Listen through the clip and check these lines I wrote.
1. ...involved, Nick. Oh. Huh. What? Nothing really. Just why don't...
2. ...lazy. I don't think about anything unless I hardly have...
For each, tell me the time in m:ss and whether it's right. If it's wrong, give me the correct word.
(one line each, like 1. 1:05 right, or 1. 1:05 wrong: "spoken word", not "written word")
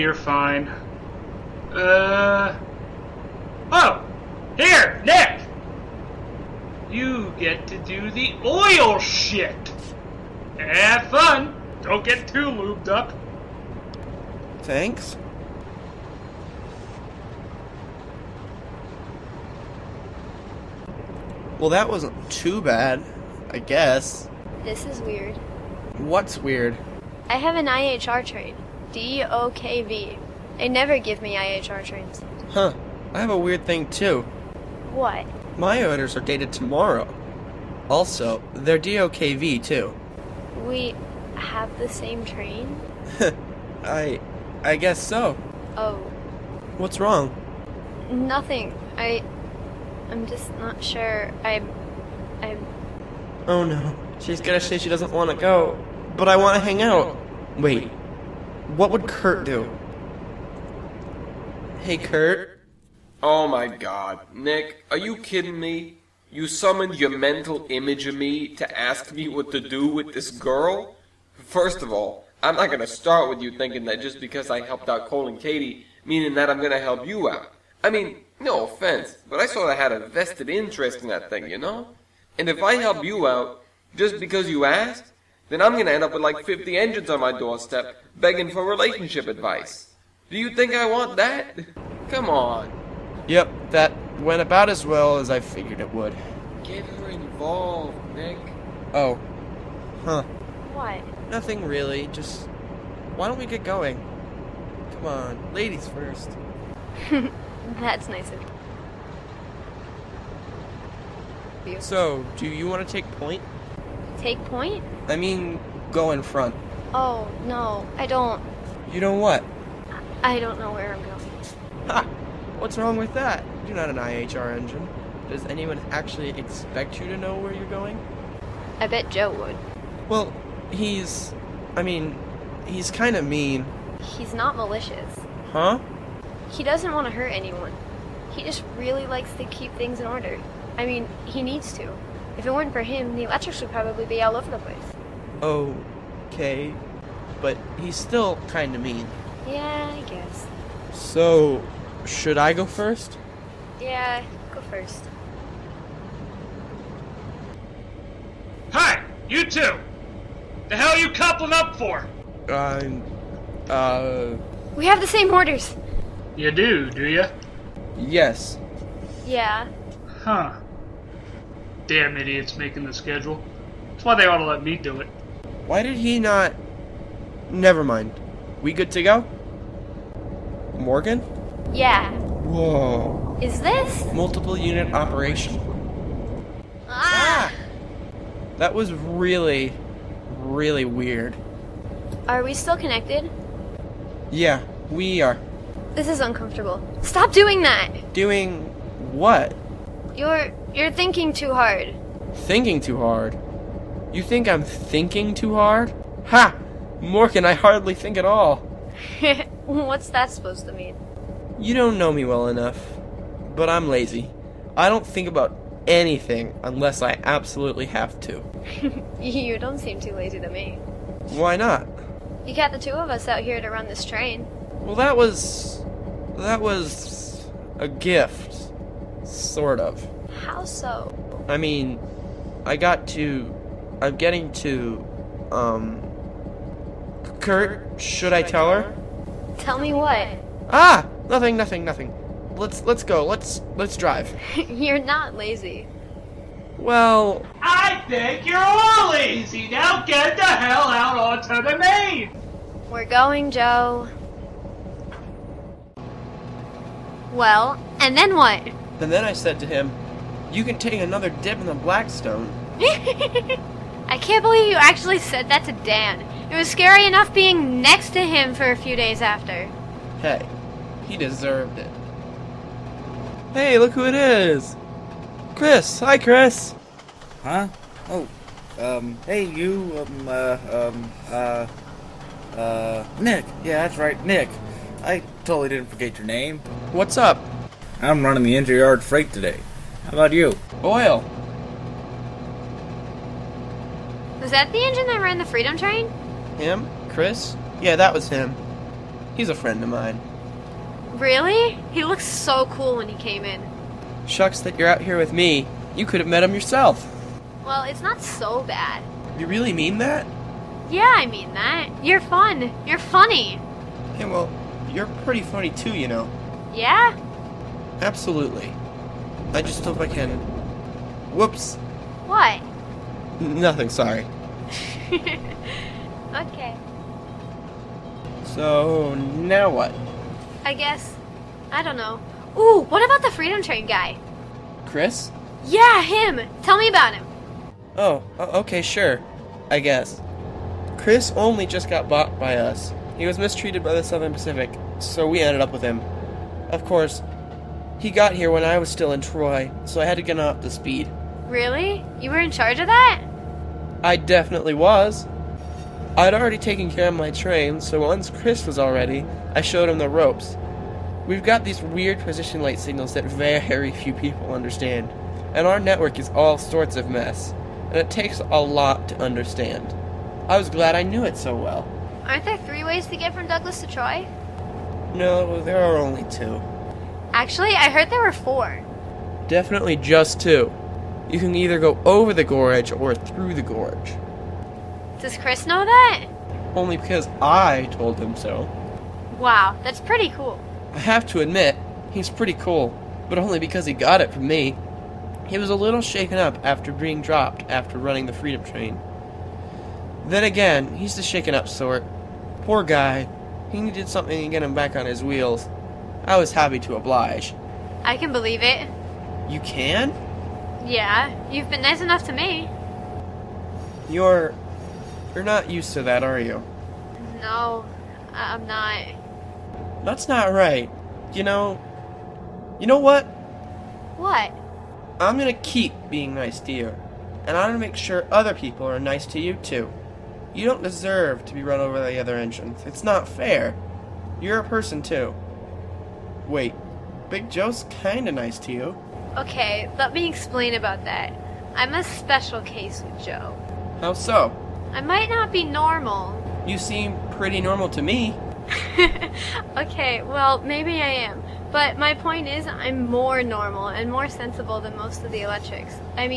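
1. 1:37 right
2. 3:33 wrong: "absolutely", not "hardly".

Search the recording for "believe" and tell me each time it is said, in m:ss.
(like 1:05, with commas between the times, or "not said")
4:24, 6:48.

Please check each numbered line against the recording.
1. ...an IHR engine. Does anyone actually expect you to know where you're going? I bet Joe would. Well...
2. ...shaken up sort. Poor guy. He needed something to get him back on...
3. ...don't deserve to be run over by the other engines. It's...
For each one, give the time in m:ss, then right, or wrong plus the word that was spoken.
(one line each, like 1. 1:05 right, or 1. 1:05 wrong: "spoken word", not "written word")
1. 2:03 right
2. 6:41 right
3. 7:10 right.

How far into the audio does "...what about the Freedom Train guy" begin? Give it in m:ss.
5:32.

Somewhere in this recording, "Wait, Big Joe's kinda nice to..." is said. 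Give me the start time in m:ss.
7:16.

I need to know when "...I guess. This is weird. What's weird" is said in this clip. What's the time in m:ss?
0:23.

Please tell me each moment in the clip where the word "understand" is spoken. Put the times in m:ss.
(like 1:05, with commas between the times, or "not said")
6:04, 6:09.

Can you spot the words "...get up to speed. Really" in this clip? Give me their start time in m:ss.
5:50.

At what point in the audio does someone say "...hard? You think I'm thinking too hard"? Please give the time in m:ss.
3:22.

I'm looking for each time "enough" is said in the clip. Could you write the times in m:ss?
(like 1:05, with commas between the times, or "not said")
3:32, 4:27, 6:52.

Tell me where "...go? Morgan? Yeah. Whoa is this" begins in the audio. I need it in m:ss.
2:59.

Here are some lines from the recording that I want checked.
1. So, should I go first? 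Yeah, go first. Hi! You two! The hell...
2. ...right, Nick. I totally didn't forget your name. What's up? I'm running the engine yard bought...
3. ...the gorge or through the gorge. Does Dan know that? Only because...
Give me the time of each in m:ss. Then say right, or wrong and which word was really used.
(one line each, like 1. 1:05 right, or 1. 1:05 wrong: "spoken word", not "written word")
1. 2:30 right
2. 4:43 wrong: "freight", not "bought"
3. 6:22 wrong: "Chris", not "Dan".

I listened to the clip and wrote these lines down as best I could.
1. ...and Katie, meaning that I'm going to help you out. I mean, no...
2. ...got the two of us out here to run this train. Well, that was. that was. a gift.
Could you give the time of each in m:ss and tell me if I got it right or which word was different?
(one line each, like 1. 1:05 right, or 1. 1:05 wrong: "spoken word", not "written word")
1. 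1:15 right
2. 3:42 right.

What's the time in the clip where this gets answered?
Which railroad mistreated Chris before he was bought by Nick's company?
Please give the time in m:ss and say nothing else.
5:44.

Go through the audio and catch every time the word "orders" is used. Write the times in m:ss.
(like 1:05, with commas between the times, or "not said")
0:35, 2:20, 2:45.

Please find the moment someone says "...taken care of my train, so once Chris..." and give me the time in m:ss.
5:56.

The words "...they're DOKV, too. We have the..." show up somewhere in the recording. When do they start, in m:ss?
0:38.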